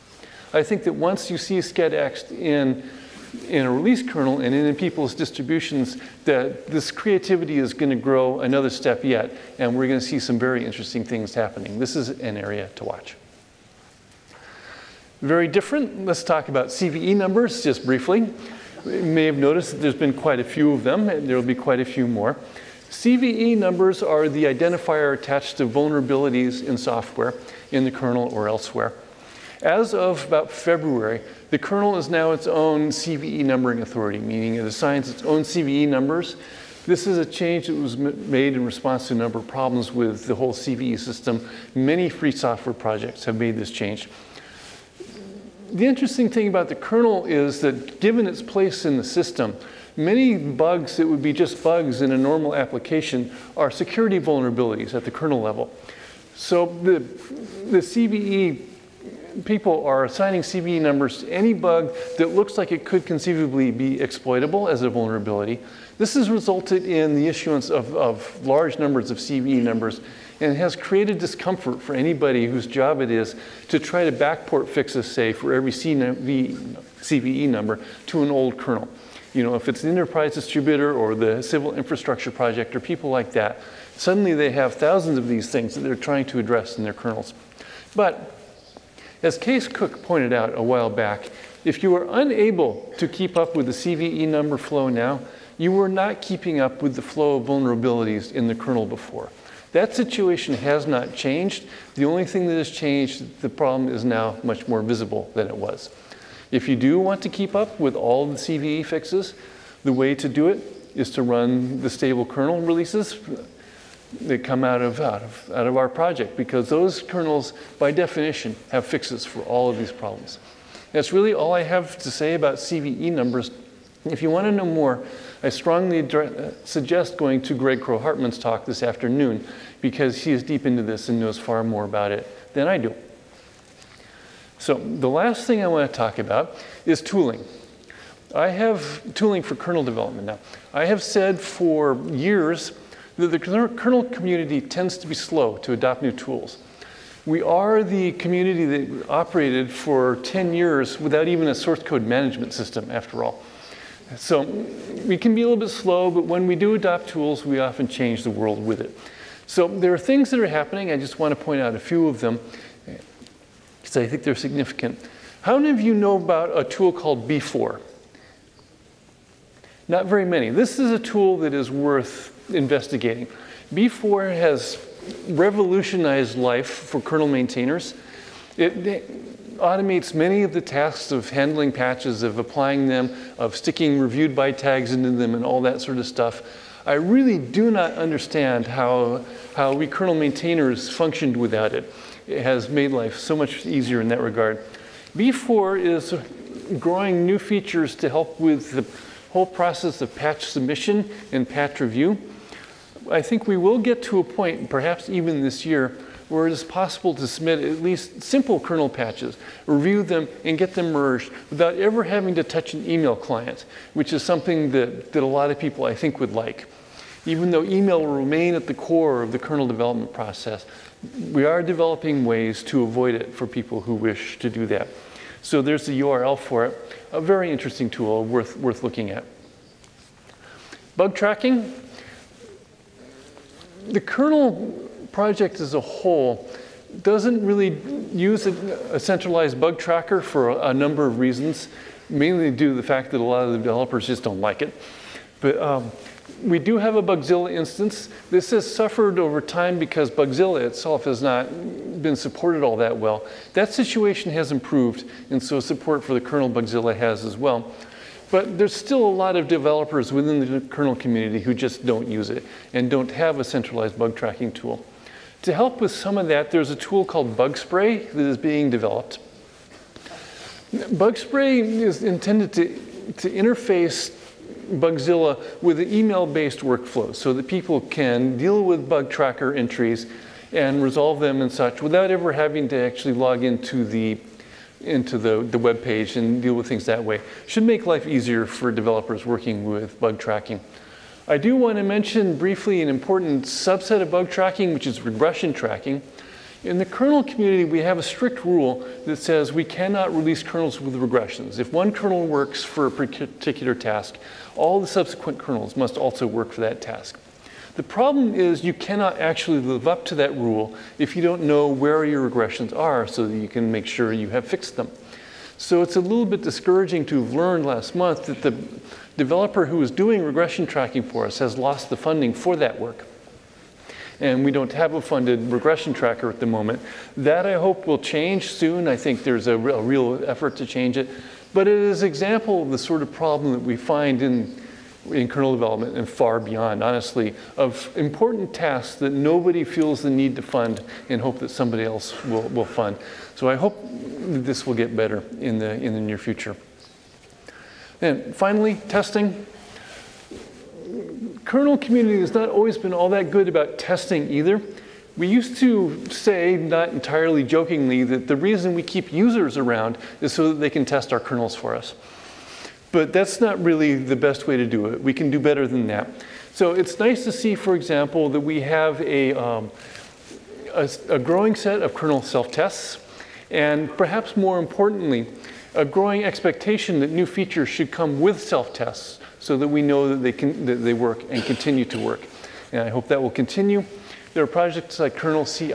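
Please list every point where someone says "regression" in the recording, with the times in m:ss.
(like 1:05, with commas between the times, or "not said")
4:55, 5:00, 5:12, 5:20, 5:25.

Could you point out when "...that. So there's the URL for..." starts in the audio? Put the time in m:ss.
3:44.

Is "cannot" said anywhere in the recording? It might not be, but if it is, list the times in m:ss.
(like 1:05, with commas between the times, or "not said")
4:59, 5:08.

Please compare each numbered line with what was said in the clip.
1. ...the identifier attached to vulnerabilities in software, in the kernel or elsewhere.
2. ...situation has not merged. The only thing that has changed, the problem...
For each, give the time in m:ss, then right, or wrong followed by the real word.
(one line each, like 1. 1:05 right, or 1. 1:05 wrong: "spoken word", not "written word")
1. 0:24 right
2. 1:39 wrong: "changed", not "merged".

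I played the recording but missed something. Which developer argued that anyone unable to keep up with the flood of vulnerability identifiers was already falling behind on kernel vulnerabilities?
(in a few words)
Kees Cook.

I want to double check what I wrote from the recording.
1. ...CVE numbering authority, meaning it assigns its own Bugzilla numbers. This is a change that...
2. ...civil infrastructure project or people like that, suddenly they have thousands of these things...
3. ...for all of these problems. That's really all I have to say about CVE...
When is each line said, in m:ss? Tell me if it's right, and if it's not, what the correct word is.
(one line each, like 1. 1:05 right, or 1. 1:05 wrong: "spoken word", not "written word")
1. 0:32 wrong: "CVE", not "Bugzilla"
2. 1:21 right
3. 1:59 right.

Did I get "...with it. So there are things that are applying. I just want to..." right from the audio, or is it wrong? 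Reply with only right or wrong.
wrong.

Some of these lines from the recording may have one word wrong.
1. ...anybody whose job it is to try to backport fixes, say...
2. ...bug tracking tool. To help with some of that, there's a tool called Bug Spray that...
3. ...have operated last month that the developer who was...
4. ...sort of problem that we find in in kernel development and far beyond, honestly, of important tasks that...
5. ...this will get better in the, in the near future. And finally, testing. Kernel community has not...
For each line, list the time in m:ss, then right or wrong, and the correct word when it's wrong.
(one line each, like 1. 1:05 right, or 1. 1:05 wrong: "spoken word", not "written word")
1. 1:11 right
2. 4:23 right
3. 5:17 wrong: "learned", not "operated"
4. 5:32 right
5. 5:43 right.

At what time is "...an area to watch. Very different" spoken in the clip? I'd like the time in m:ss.
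0:12.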